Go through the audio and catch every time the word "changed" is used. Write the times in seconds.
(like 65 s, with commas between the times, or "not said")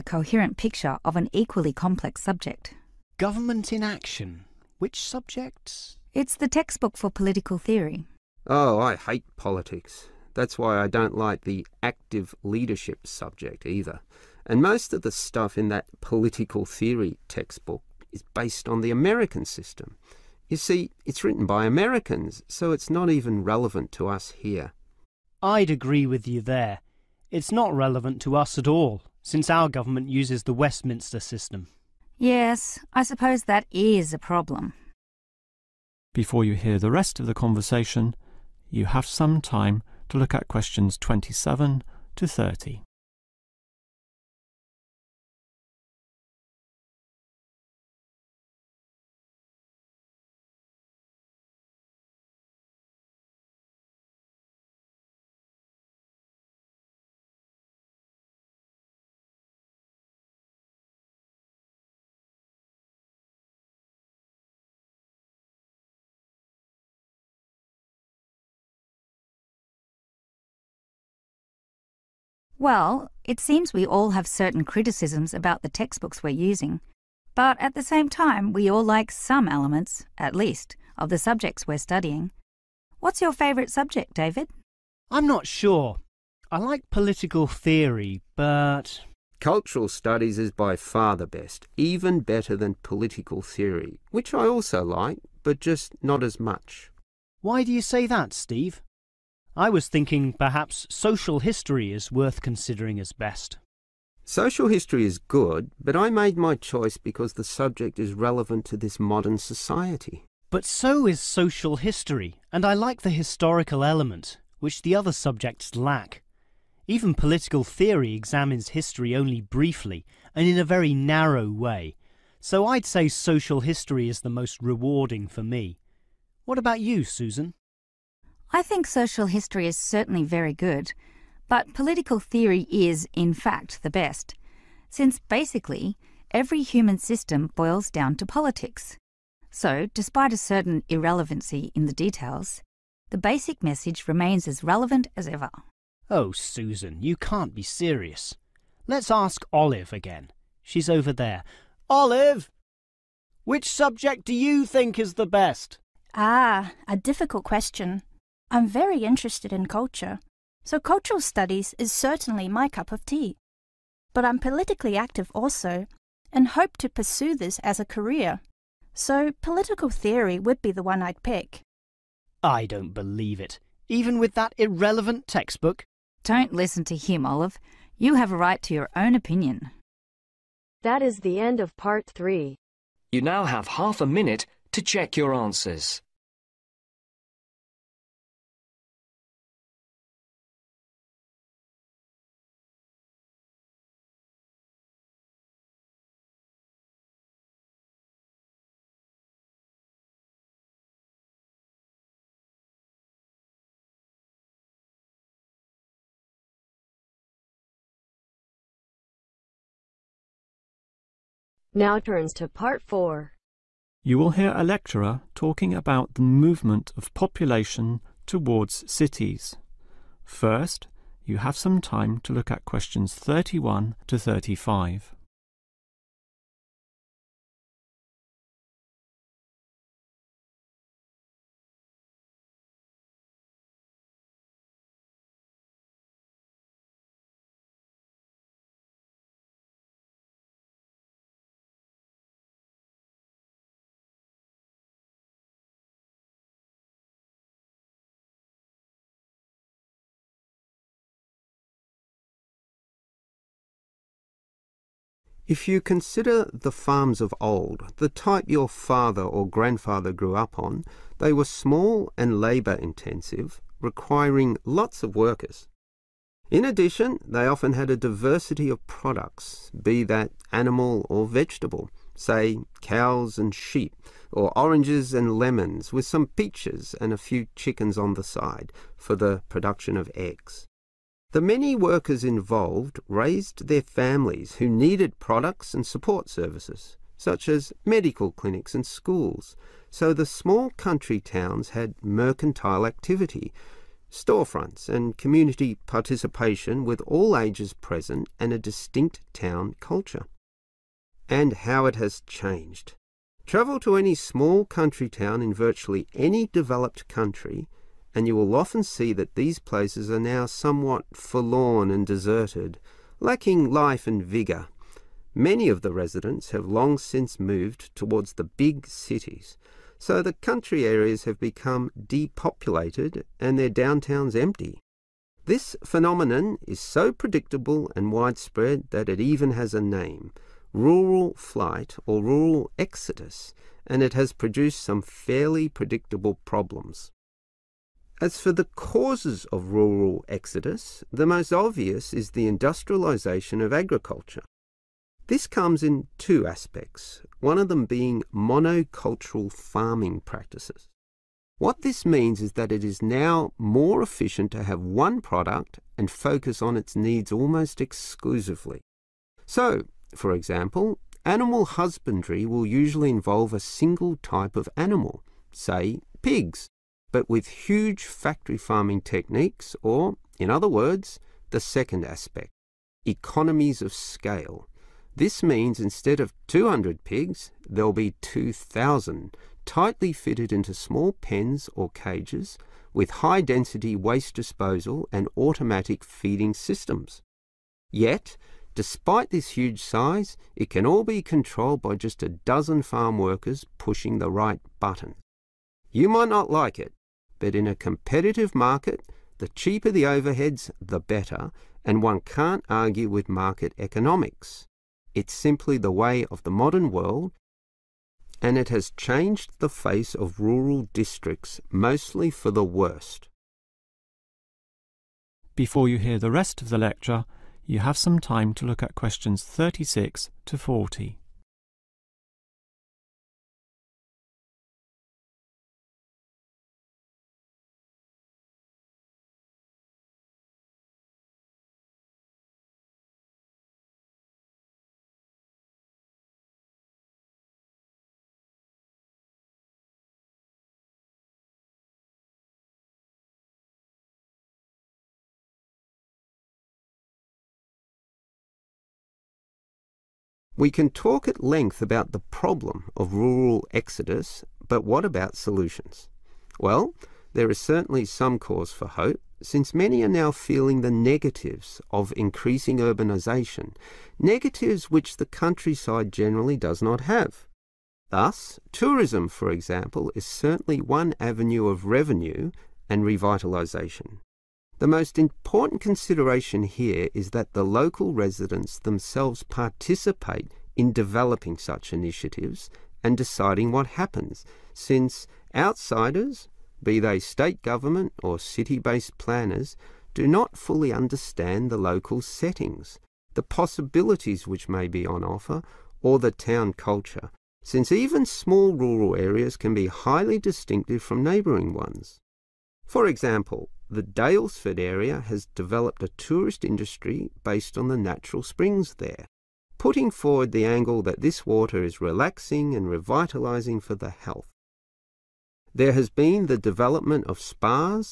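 302 s, 408 s.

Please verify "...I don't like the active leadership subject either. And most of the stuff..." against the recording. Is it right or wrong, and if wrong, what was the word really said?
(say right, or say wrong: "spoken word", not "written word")
right.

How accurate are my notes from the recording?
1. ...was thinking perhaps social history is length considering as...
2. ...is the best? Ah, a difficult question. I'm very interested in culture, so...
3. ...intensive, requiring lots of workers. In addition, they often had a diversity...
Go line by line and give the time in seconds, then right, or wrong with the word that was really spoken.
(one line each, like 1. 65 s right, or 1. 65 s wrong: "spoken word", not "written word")
1. 99 s wrong: "worth", not "length"
2. 154 s right
3. 262 s right.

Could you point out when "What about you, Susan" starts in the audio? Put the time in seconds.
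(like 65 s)
126 s.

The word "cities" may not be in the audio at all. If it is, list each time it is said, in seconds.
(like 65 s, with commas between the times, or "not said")
218 s, 318 s.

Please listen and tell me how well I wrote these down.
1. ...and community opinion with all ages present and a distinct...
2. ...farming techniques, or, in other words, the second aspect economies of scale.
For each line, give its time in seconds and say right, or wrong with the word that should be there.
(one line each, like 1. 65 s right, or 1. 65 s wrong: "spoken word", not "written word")
1. 294 s wrong: "participation", not "opinion"
2. 368 s right.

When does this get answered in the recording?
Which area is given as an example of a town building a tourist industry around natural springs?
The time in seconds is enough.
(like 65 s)
504 s.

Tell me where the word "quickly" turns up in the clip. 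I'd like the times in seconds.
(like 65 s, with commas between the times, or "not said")
not said.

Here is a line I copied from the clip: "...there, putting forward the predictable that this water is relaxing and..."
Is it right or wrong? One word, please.
wrong.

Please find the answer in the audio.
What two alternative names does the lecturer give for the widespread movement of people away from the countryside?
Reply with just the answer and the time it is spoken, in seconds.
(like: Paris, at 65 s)
Rural flight or rural exodus, at 330 s.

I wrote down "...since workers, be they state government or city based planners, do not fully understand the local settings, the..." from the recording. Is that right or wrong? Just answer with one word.
wrong.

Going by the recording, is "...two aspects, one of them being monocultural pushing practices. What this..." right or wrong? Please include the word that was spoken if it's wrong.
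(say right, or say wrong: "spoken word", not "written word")
wrong: "farming", not "pushing".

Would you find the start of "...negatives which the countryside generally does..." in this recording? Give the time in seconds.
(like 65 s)
464 s.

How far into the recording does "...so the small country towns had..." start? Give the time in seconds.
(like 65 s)
289 s.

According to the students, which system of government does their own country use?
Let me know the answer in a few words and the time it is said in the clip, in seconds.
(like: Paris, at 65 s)
Westminster system, at 30 s.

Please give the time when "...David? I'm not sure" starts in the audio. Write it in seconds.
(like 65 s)
84 s.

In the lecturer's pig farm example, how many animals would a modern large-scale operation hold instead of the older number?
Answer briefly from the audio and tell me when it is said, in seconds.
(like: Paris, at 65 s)
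2,000, at 378 s.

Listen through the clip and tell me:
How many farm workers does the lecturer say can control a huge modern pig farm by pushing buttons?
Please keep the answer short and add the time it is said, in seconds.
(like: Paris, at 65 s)
A dozen, at 392 s.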